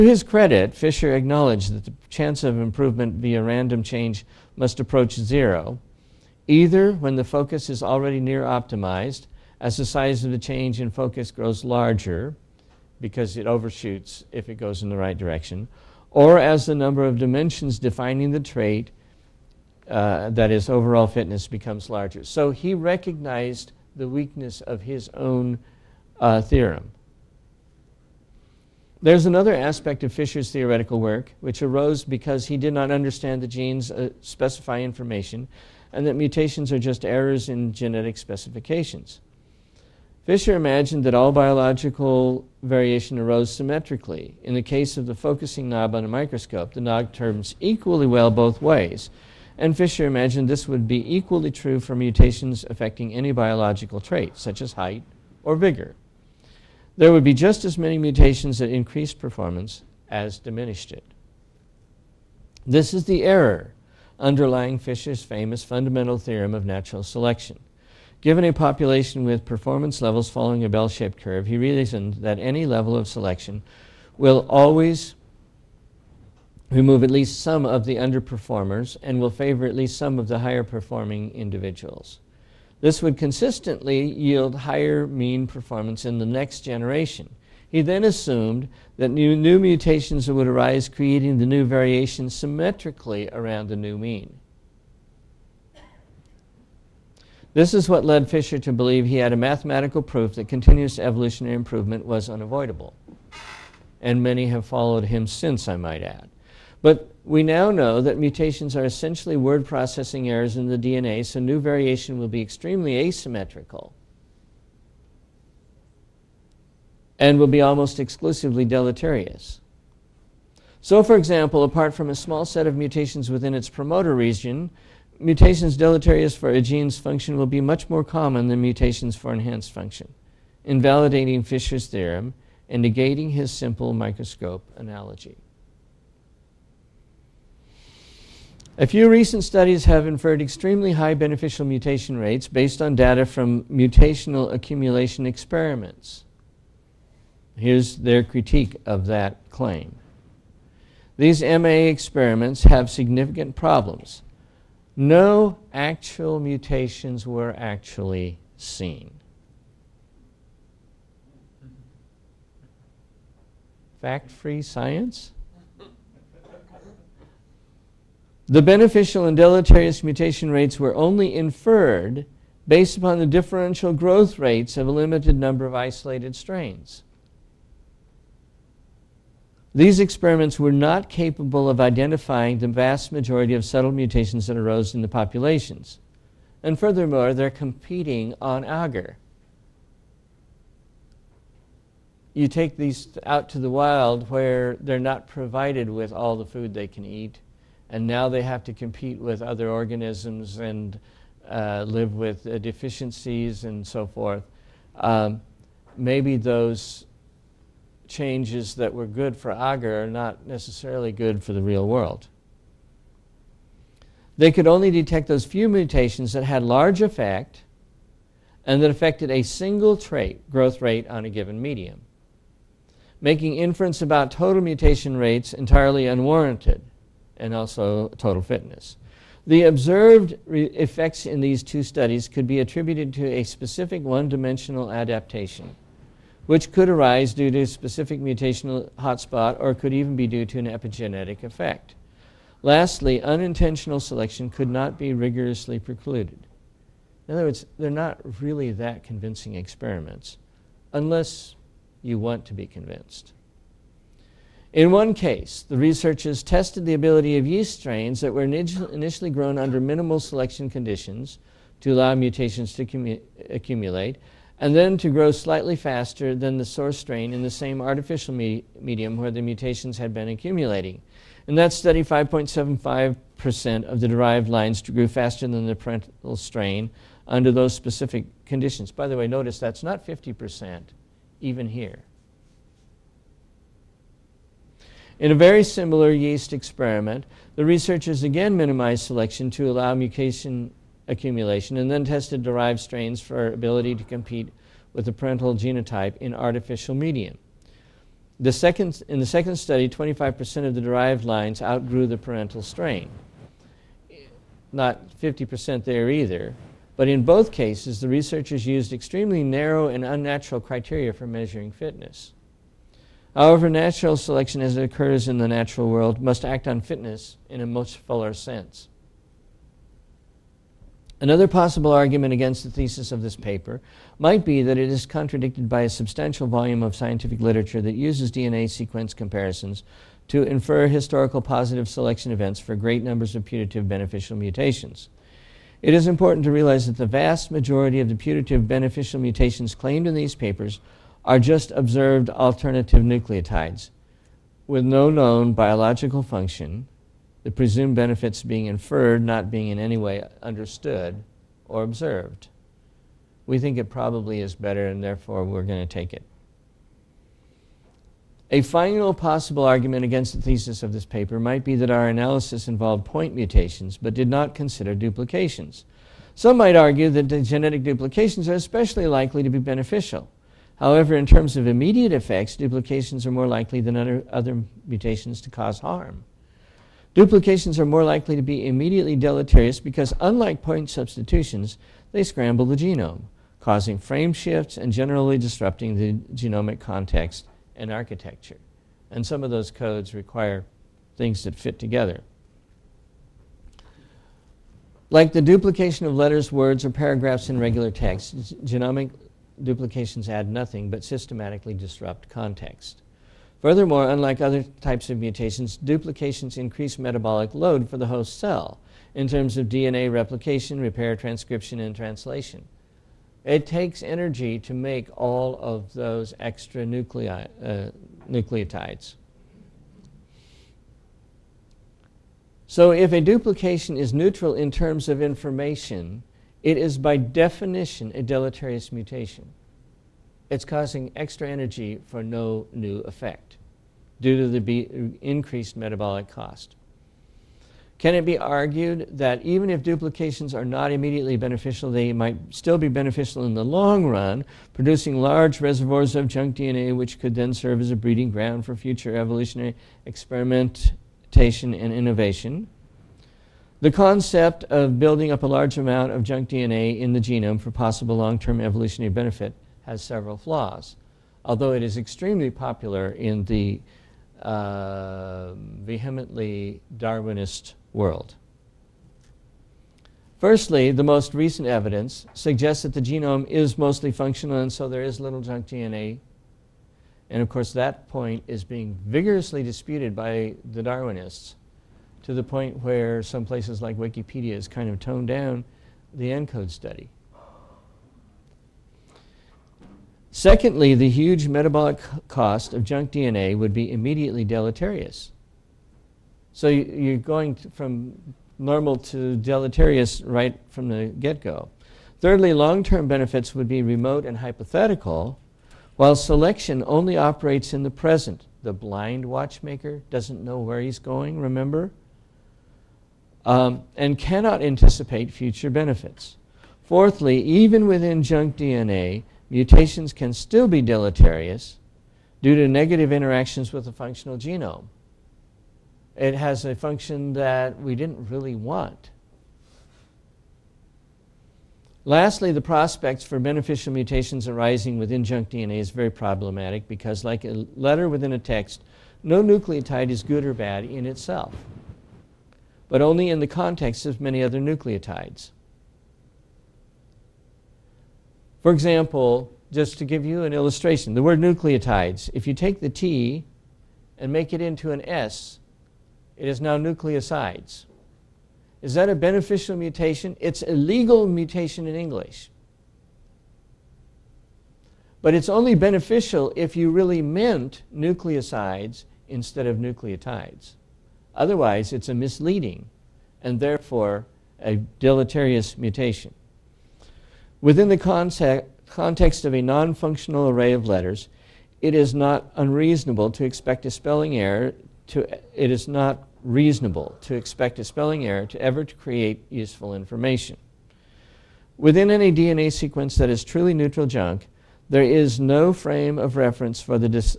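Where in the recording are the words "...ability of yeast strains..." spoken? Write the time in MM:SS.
04:16.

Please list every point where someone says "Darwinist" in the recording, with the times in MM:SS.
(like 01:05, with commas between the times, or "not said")
07:46, 08:00.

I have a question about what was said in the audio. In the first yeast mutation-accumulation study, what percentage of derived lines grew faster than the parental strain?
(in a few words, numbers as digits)
5.75%.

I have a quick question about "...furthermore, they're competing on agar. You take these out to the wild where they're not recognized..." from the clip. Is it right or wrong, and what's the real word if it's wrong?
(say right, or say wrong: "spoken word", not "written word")
wrong: "provided", not "recognized".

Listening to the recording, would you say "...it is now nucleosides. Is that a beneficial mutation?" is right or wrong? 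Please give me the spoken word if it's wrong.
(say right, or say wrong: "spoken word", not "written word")
right.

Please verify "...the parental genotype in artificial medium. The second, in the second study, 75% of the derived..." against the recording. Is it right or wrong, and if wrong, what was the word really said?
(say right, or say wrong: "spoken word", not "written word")
wrong: "25", not "75".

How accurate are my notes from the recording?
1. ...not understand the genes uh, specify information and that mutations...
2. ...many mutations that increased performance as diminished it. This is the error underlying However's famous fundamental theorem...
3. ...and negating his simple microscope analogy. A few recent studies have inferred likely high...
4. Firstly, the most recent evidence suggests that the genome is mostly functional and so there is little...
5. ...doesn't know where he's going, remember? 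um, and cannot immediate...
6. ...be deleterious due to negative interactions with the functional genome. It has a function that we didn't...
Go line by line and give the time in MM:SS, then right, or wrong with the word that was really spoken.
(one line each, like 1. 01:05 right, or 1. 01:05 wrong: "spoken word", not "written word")
1. 00:32 right
2. 00:57 wrong: "Fisher", not "However"
3. 02:12 wrong: "extremely", not "likely"
4. 07:50 right
5. 08:30 wrong: "anticipate", not "immediate"
6. 08:40 right.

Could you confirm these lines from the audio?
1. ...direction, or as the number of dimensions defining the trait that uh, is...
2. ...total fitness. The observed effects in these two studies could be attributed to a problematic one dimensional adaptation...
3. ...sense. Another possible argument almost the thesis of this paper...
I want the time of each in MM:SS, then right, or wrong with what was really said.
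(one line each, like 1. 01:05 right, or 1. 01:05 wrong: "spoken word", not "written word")
1. 00:15 right
2. 03:48 wrong: "specific", not "problematic"
3. 05:18 wrong: "against", not "almost".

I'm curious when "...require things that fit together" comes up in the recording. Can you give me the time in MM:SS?
06:30.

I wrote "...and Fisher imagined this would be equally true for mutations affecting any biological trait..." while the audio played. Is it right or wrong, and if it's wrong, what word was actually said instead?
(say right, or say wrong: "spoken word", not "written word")
right.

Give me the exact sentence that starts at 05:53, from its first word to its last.
We think it probably is better, and therefore we're going to take it.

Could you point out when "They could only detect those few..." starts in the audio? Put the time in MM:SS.
03:34.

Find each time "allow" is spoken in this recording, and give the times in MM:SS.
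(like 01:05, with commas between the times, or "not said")
04:21, 04:49.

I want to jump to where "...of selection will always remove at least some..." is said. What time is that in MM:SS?
01:12.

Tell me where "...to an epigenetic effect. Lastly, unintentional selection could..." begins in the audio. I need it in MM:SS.
04:00.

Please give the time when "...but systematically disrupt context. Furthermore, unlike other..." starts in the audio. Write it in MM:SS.
06:40.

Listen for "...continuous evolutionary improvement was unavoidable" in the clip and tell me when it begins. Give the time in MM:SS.
01:40.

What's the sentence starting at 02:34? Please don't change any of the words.
No actual mutations were actually seen.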